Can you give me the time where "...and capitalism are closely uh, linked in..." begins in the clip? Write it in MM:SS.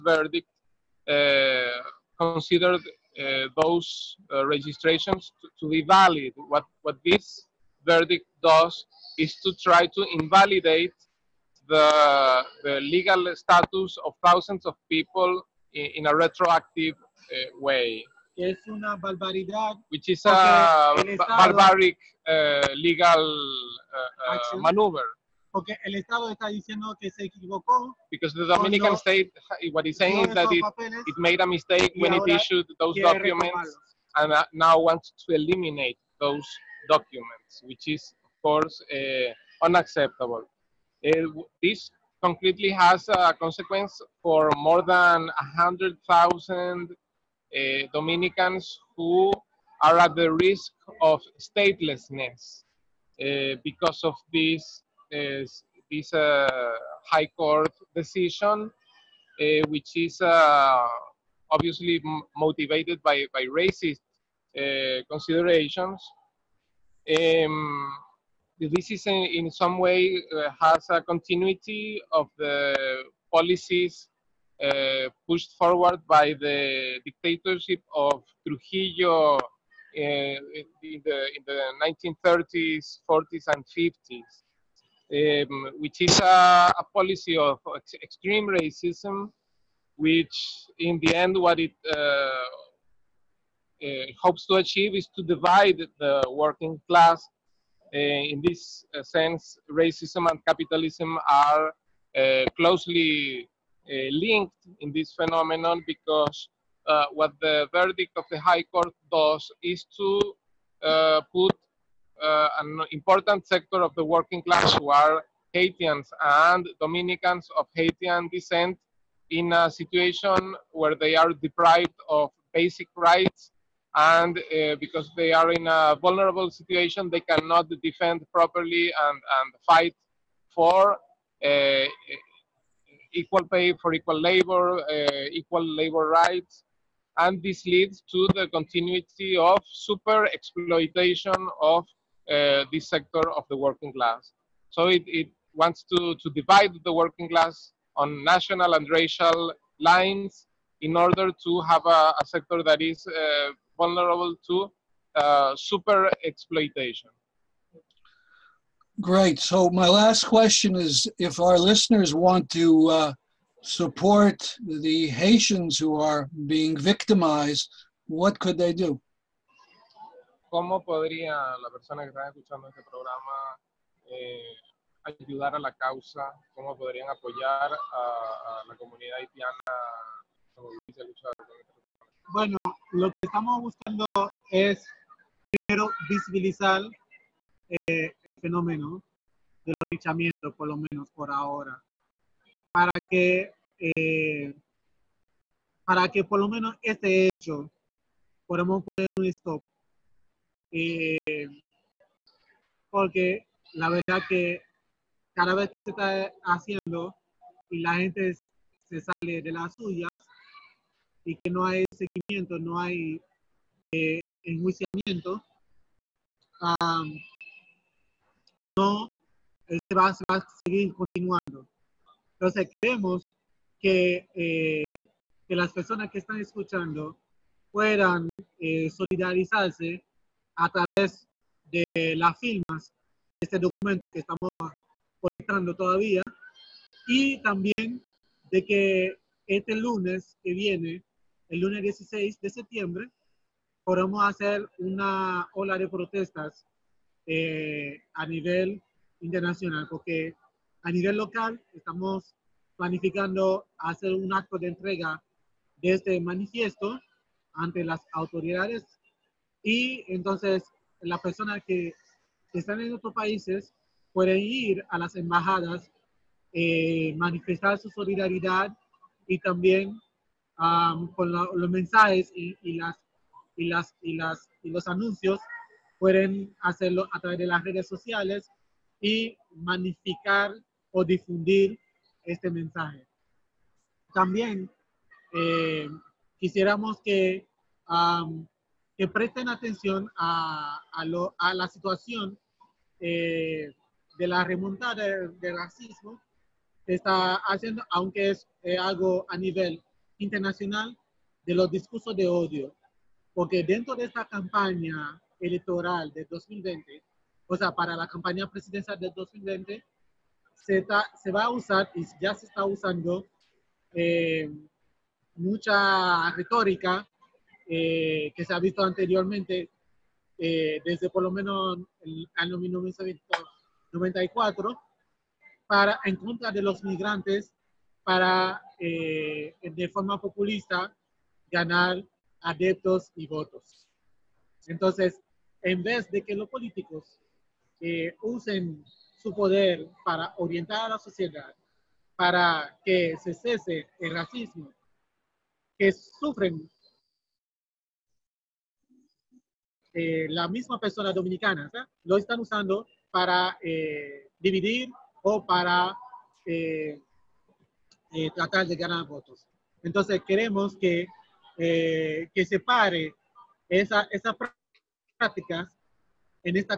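01:40.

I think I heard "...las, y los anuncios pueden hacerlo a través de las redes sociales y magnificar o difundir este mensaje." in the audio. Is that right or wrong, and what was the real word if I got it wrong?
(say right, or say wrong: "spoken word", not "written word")
right.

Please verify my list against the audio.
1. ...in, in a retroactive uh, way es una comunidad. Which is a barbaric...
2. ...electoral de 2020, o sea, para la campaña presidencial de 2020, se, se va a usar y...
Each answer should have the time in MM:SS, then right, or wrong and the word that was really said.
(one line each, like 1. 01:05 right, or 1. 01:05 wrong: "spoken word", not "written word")
1. 00:15 wrong: "barbaridad", not "comunidad"
2. 05:05 right.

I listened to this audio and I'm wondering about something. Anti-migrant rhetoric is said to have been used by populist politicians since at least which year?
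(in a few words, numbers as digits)
1994.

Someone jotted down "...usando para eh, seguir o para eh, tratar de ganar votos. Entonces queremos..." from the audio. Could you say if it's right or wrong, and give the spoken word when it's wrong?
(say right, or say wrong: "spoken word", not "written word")
wrong: "dividir", not "seguir".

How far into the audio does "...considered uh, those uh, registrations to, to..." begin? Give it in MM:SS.
00:02.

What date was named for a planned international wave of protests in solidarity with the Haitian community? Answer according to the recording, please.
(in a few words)
Monday, September 16.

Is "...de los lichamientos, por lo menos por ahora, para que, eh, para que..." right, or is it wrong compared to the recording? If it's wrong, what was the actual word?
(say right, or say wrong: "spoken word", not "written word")
right.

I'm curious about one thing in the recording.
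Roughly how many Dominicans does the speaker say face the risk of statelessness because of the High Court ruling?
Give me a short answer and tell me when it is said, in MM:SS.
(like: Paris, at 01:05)
100,000, at 00:45.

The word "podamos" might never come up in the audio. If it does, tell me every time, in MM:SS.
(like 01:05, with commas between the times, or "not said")
03:18, 04:03.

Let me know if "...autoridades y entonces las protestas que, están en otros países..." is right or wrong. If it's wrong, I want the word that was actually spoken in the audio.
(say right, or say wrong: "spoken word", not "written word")
wrong: "personas", not "protestas".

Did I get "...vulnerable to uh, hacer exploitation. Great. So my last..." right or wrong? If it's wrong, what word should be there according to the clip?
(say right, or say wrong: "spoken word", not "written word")
wrong: "super", not "hacer".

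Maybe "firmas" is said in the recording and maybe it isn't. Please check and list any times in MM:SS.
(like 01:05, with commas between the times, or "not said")
03:52.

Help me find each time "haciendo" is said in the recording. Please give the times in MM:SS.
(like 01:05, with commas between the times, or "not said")
03:26, 04:57.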